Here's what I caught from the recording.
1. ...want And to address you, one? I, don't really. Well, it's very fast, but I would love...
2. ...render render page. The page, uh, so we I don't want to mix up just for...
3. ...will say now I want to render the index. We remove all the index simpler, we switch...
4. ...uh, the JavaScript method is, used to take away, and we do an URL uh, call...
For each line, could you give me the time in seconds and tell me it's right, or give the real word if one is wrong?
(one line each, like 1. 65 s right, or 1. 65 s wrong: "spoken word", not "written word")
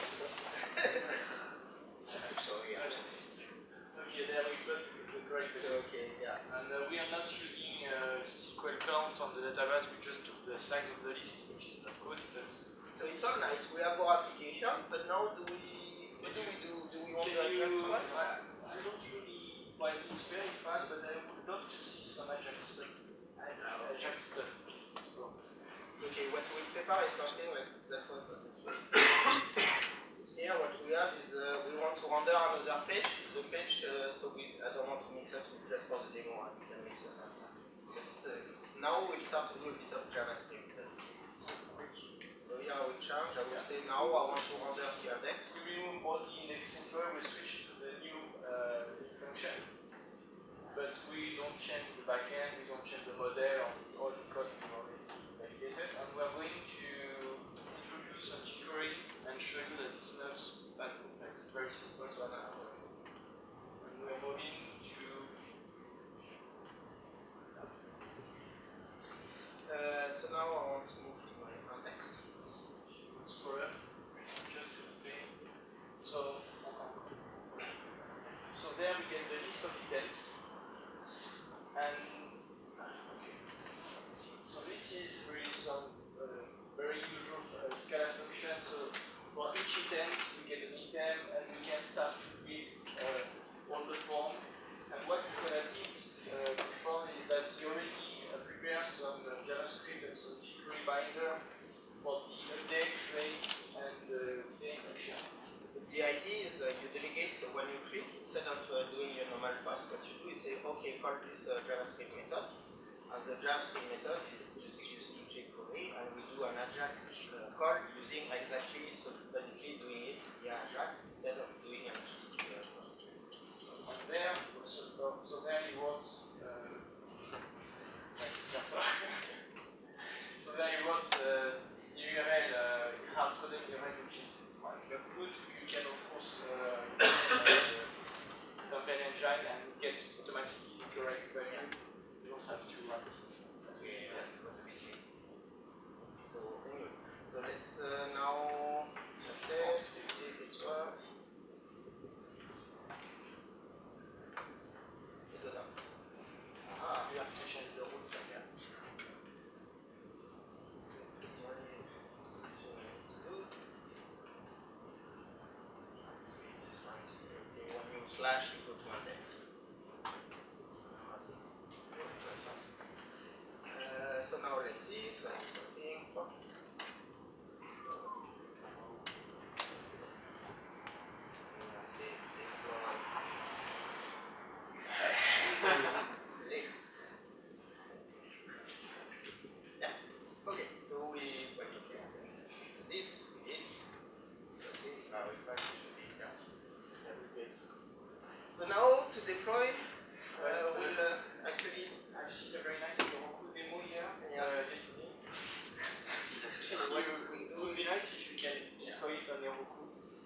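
1. 17 s wrong: "Can", not "And"
2. 32 s wrong: "another", not "render"
3. 43 s right
4. 113 s wrong: "Ajax", not "URL".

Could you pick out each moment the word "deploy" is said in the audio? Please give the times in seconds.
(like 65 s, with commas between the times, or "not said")
199 s, 208 s.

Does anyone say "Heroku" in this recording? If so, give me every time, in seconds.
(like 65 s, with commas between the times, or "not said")
202 s, 209 s.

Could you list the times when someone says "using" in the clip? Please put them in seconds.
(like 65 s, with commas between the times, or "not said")
7 s, 118 s.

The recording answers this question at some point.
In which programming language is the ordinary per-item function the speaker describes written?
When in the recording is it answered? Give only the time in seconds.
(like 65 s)
87 s.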